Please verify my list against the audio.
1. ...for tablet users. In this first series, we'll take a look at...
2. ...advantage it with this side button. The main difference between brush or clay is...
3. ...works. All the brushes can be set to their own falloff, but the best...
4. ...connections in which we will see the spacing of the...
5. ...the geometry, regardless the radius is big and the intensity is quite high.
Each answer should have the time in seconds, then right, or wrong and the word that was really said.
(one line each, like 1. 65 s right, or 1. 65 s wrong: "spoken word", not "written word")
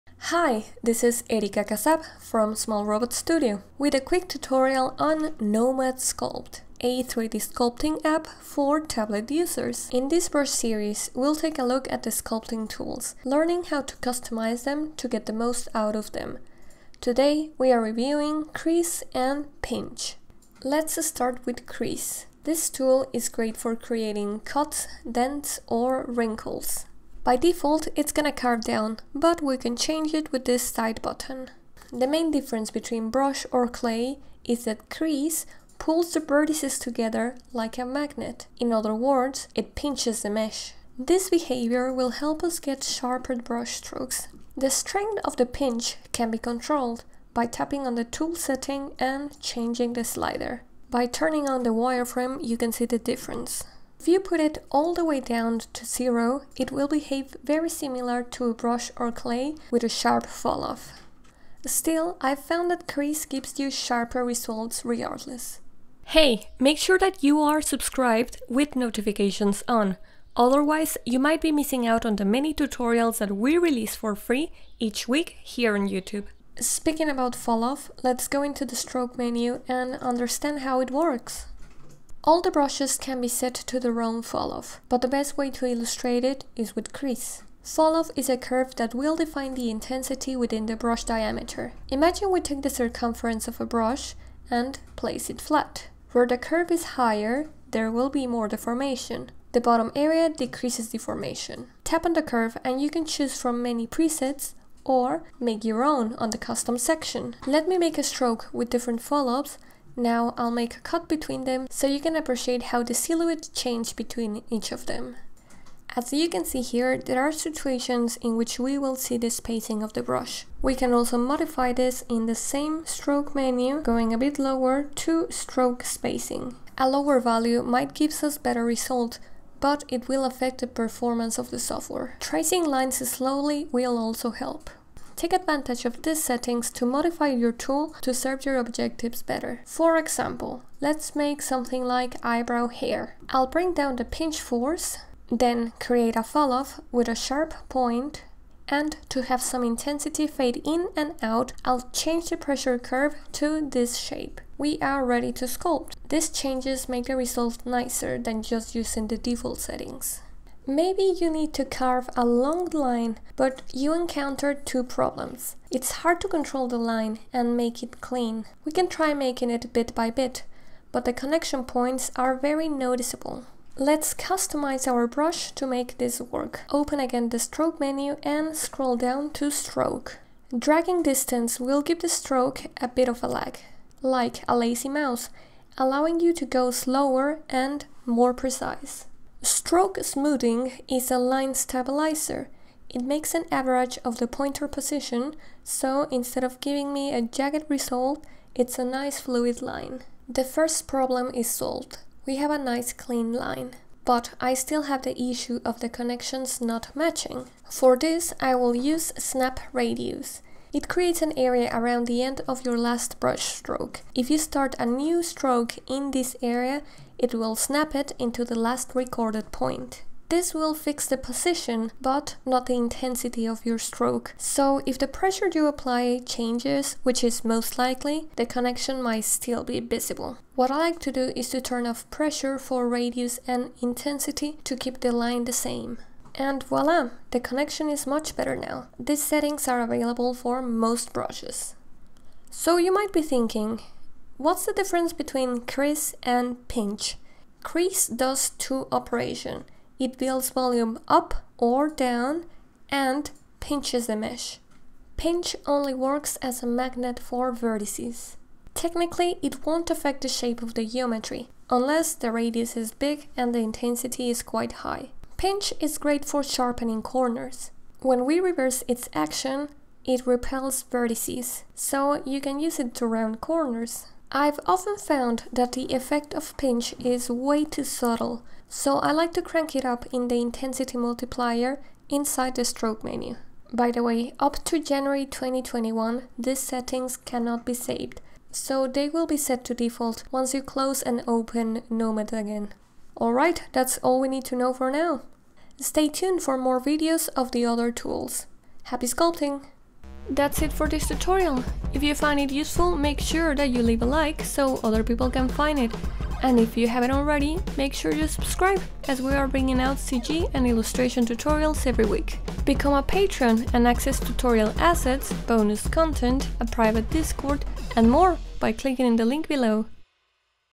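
1. 8 s right
2. 29 s wrong: "change", not "advantage"
3. 80 s right
4. 117 s wrong: "situations", not "connections"
5. 260 s wrong: "unless", not "regardless".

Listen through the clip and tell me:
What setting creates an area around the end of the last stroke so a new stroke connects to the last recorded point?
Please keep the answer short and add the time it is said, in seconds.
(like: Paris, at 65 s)
Snap radius, at 209 s.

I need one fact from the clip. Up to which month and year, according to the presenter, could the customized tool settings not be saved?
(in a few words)
January 2021.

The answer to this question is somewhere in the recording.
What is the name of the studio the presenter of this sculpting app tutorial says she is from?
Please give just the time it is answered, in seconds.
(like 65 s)
2 s.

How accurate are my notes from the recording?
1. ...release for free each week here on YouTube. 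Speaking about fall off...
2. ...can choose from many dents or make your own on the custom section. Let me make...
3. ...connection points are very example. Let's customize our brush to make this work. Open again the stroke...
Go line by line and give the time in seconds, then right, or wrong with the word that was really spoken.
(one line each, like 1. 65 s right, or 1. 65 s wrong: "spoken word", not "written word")
1. 73 s right
2. 102 s wrong: "presets", not "dents"
3. 171 s wrong: "noticeable", not "example".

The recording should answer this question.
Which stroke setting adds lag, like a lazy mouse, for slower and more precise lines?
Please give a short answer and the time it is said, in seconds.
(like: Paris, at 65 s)
Dragging distance, at 180 s.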